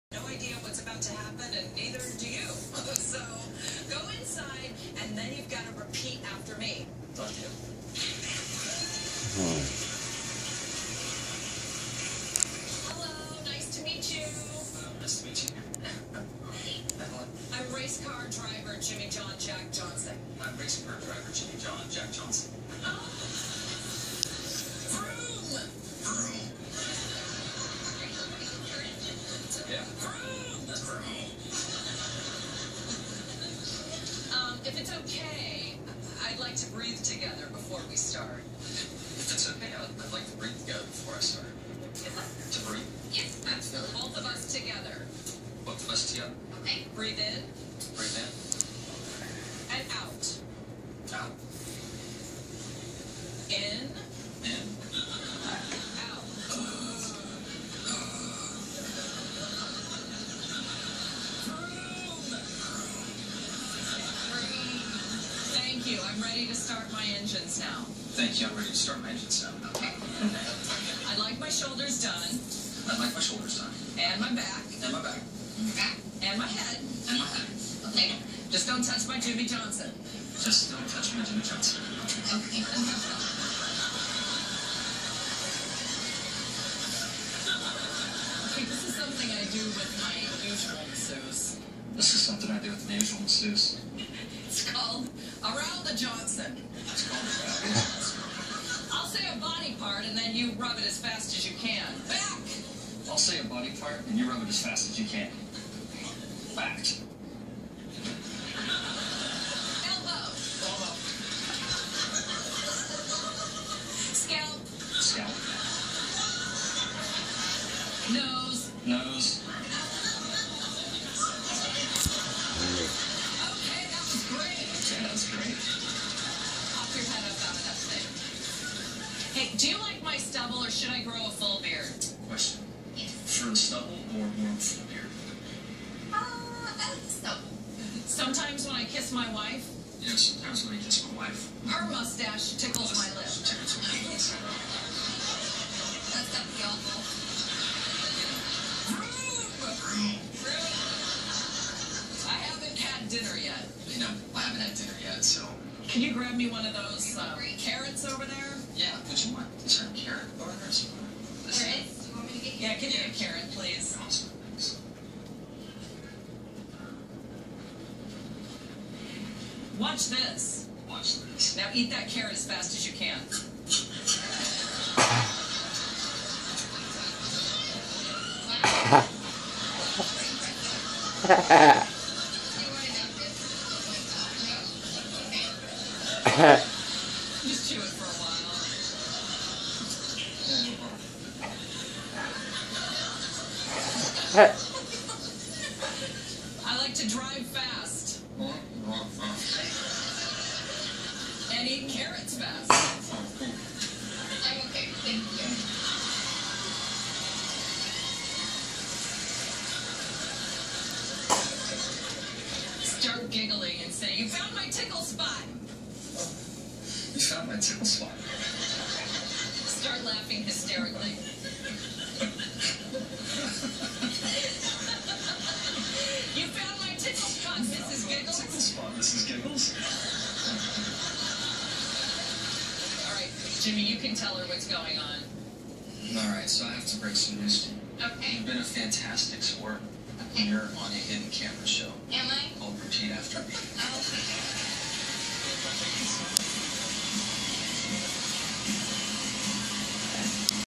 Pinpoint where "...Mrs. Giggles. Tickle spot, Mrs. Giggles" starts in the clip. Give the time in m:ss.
3:47.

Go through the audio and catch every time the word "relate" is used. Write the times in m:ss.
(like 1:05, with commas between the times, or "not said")
not said.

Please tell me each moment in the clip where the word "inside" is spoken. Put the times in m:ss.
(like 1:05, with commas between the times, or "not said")
0:04.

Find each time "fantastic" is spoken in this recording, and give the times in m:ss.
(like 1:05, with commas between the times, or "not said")
3:58.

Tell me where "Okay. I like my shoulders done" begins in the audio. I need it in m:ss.
1:09.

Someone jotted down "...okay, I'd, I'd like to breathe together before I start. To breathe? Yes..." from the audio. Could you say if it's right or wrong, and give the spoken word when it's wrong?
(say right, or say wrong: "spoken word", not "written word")
right.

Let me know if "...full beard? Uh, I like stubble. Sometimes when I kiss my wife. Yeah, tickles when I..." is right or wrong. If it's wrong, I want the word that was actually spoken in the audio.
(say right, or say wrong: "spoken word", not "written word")
wrong: "sometimes", not "tickles".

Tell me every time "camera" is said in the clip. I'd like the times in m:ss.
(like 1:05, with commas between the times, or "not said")
4:01.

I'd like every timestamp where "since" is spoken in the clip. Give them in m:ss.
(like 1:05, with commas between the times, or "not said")
3:37.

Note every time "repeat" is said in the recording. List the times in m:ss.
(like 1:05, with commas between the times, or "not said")
0:05, 4:02.